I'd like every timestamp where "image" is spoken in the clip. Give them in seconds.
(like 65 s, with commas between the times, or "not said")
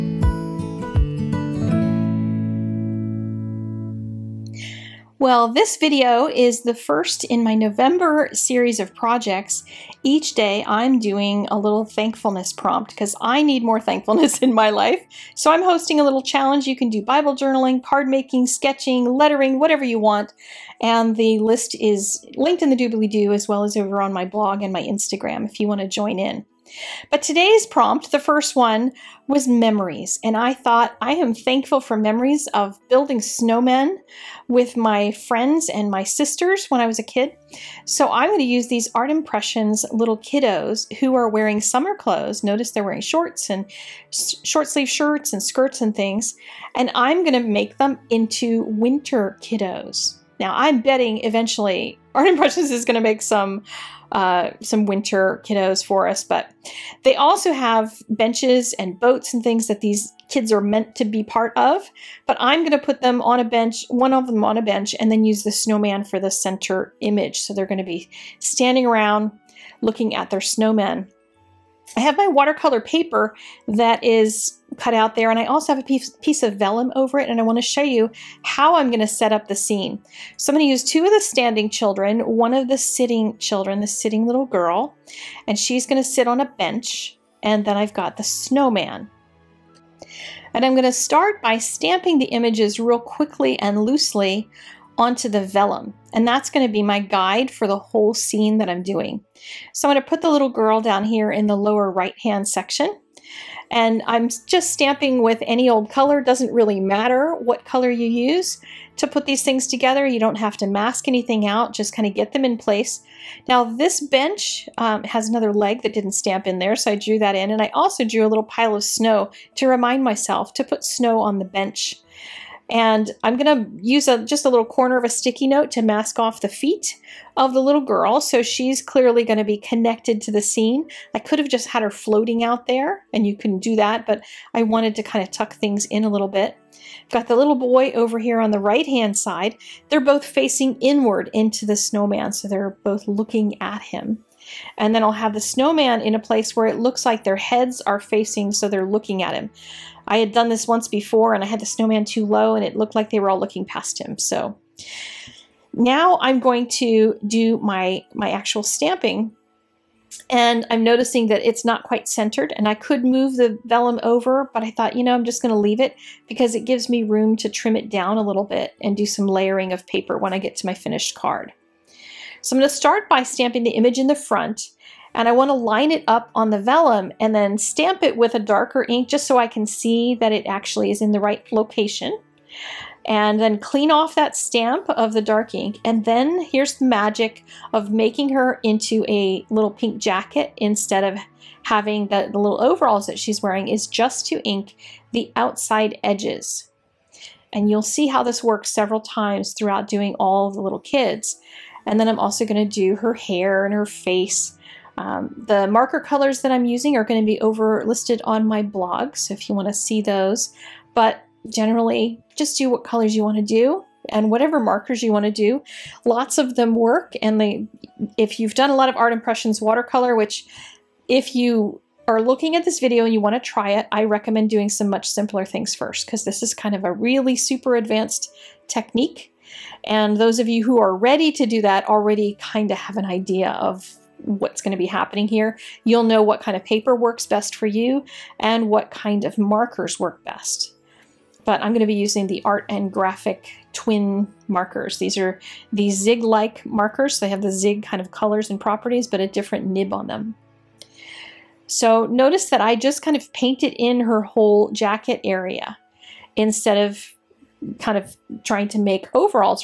67 s, 92 s, 173 s.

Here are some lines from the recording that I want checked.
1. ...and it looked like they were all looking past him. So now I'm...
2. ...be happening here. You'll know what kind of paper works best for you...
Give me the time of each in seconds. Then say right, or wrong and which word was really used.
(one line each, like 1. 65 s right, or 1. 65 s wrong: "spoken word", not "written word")
1. 152 s right
2. 234 s right.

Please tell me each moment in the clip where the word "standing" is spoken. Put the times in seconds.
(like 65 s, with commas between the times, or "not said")
68 s, 81 s.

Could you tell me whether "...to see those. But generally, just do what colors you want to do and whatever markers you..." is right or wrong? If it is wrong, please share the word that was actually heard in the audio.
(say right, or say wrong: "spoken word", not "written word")
right.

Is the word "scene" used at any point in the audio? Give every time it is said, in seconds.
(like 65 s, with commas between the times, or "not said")
79 s, 98 s, 130 s.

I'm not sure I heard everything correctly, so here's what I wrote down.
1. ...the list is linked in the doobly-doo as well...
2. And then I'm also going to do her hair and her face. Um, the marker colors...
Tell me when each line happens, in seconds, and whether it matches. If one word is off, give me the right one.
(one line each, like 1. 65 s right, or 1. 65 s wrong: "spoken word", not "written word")
1. 21 s right
2. 201 s right.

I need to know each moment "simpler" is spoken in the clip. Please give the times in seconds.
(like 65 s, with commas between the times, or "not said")
225 s.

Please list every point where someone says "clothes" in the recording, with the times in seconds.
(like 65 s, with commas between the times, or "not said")
41 s.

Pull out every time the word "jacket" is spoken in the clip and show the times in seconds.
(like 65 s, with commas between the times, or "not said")
189 s, 254 s.